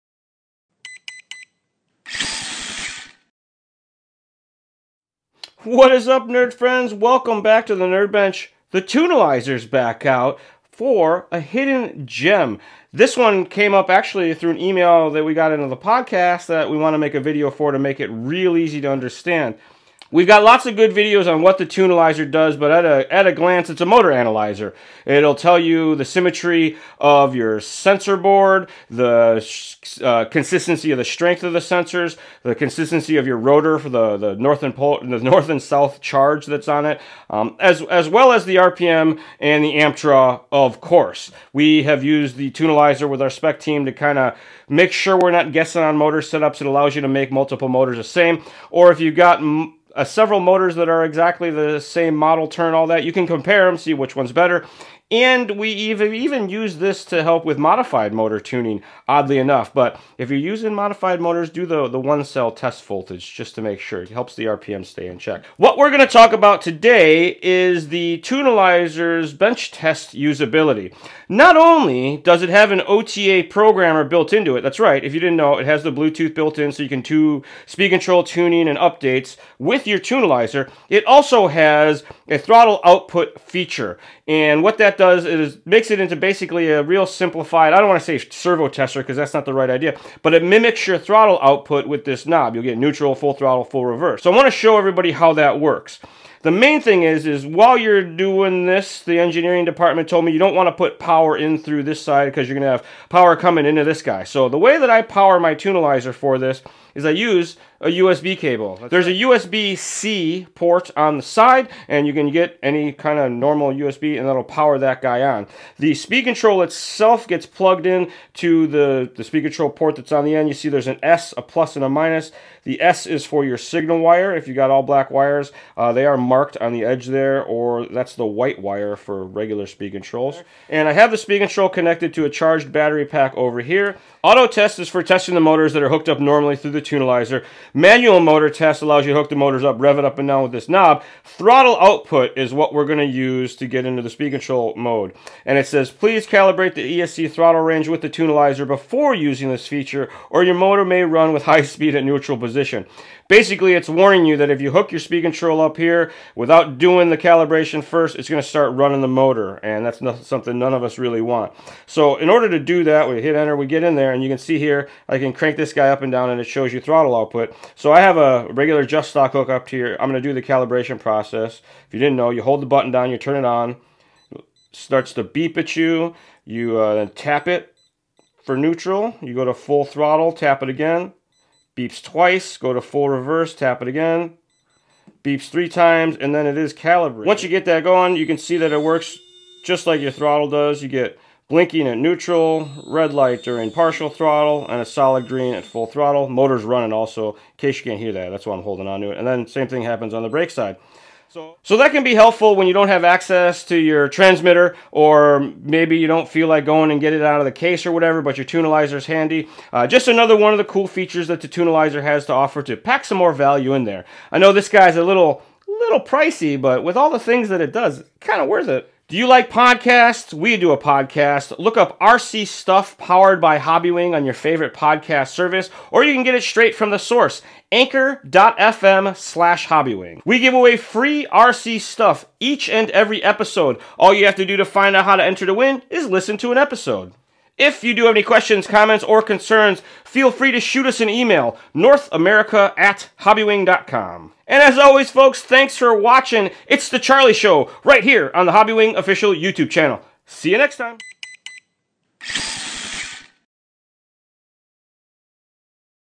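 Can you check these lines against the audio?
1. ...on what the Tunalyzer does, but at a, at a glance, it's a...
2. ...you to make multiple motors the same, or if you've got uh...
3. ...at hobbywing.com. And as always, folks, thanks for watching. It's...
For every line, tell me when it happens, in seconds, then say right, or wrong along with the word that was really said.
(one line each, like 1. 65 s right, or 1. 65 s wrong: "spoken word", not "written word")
1. 21 s right
2. 46 s right
3. 242 s right.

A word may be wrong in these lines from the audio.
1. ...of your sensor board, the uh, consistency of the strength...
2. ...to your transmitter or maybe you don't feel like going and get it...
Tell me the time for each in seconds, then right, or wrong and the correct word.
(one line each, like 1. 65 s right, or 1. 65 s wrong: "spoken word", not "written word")
1. 26 s right
2. 203 s right.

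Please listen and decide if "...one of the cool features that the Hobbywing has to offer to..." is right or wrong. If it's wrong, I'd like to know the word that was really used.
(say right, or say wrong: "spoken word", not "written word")
wrong: "Tunalyzer", not "Hobbywing".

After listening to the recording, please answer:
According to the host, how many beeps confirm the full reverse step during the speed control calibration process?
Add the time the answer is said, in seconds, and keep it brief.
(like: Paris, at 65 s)
3, at 185 s.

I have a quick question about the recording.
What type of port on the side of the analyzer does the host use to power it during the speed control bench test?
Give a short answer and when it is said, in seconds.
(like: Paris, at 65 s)
USB-C, at 109 s.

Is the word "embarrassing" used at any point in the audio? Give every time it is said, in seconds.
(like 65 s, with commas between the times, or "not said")
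not said.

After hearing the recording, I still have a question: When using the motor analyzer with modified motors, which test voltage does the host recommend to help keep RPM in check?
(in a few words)
One cell.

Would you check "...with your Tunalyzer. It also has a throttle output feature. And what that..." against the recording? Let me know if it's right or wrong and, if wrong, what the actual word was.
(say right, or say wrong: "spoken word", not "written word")
right.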